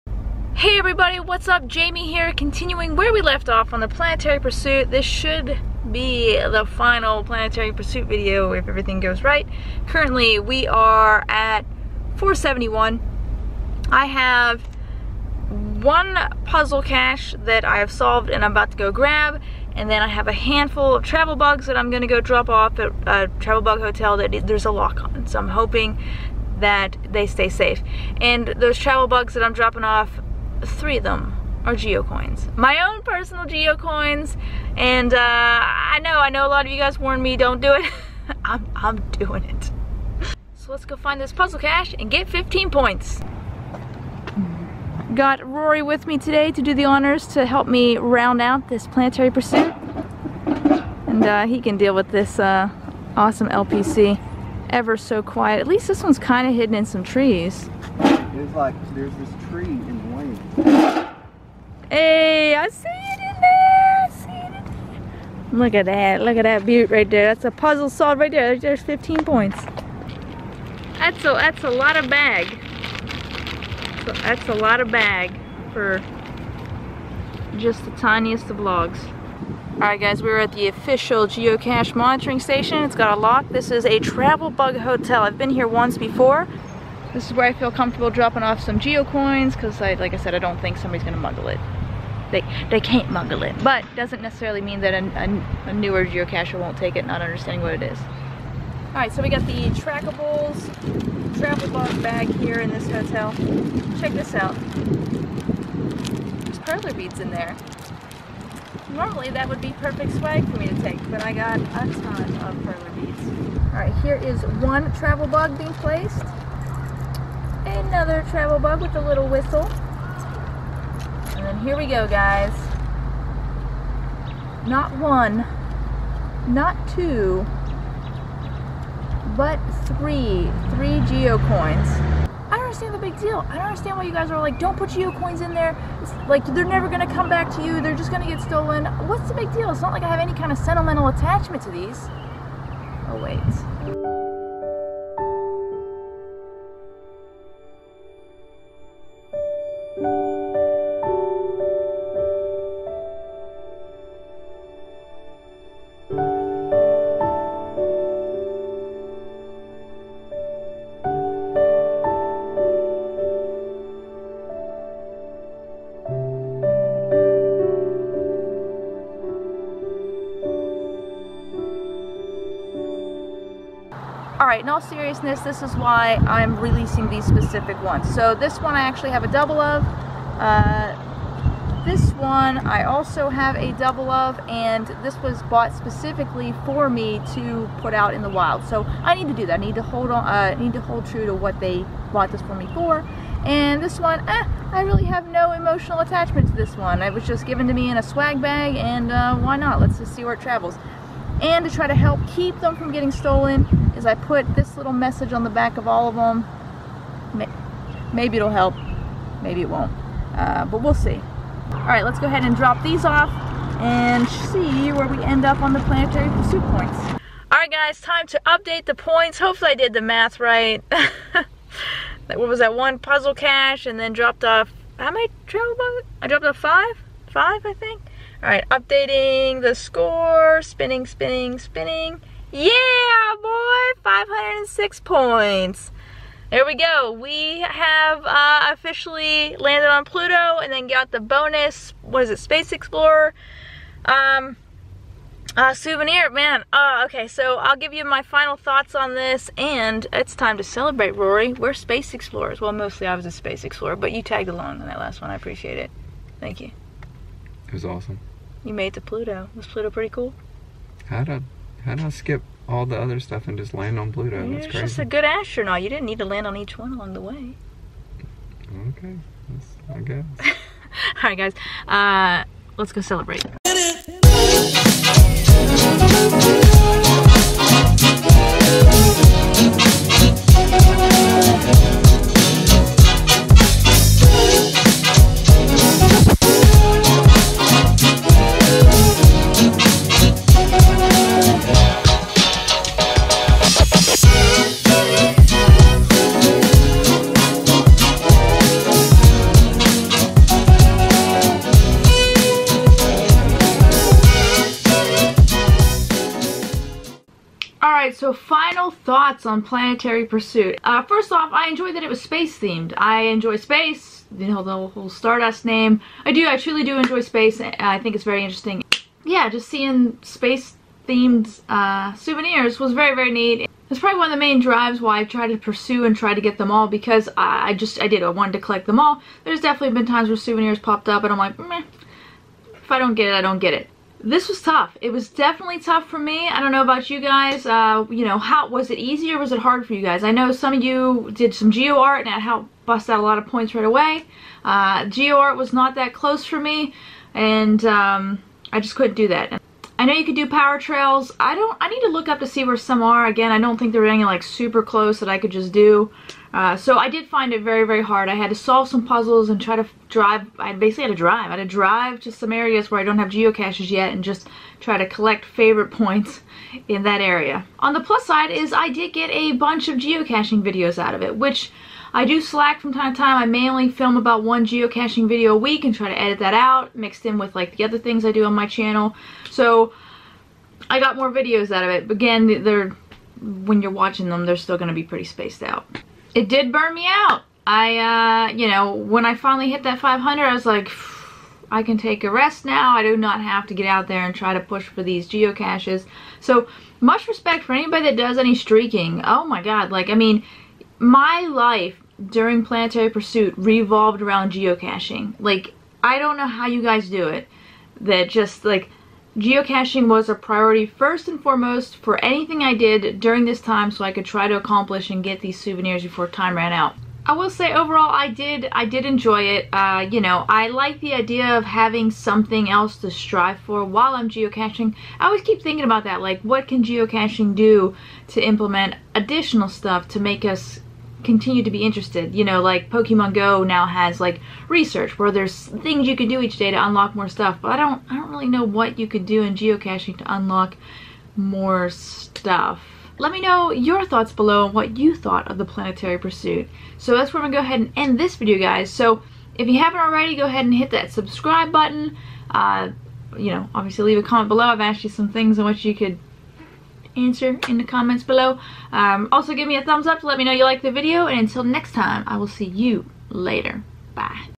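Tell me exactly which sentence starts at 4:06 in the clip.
Man, uh, okay, so I'll give you my final thoughts on this and it's time to celebrate, Rory.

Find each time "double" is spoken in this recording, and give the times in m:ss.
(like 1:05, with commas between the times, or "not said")
2:59, 3:03.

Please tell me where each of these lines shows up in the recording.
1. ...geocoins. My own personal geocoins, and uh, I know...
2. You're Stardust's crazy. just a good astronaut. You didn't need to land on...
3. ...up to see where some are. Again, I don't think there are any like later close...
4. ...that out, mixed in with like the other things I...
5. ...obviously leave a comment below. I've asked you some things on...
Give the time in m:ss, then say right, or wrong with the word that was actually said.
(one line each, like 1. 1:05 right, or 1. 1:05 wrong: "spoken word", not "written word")
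1. 0:31 right
2. 4:24 wrong: "That", not "Stardust"
3. 5:52 wrong: "super", not "later"
4. 6:16 right
5. 7:33 right.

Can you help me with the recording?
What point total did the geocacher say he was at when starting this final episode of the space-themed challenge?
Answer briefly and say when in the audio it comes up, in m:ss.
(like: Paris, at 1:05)
471, at 0:12.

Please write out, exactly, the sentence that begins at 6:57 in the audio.
I will say overall I did I did enjoy it.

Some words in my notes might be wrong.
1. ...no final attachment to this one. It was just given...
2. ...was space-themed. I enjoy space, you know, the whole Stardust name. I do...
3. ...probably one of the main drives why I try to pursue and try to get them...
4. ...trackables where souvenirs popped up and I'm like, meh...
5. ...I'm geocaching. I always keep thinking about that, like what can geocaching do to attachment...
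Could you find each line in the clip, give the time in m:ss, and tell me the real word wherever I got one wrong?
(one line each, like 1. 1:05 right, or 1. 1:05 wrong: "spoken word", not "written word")
1. 3:15 wrong: "emotional", not "final"
2. 5:12 right
3. 5:23 right
4. 5:30 wrong: "times", not "trackables"
5. 7:04 wrong: "implement", not "attachment".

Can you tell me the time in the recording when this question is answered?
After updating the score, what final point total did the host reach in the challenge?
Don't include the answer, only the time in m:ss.
3:54.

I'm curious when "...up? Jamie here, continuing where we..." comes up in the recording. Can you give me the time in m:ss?
0:01.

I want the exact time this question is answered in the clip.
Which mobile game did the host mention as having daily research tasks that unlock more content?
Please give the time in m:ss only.
7:12.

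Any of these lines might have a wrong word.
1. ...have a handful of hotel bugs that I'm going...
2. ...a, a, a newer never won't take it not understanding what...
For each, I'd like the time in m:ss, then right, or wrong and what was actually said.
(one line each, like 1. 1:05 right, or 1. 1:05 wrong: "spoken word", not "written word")
1. 0:20 wrong: "travel", not "hotel"
2. 1:34 wrong: "geocacher", not "never".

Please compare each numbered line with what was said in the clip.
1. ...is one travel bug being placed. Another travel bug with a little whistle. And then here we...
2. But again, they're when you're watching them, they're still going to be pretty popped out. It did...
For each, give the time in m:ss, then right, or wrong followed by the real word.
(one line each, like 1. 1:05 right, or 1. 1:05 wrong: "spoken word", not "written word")
1. 1:54 right
2. 6:22 wrong: "spaced", not "popped".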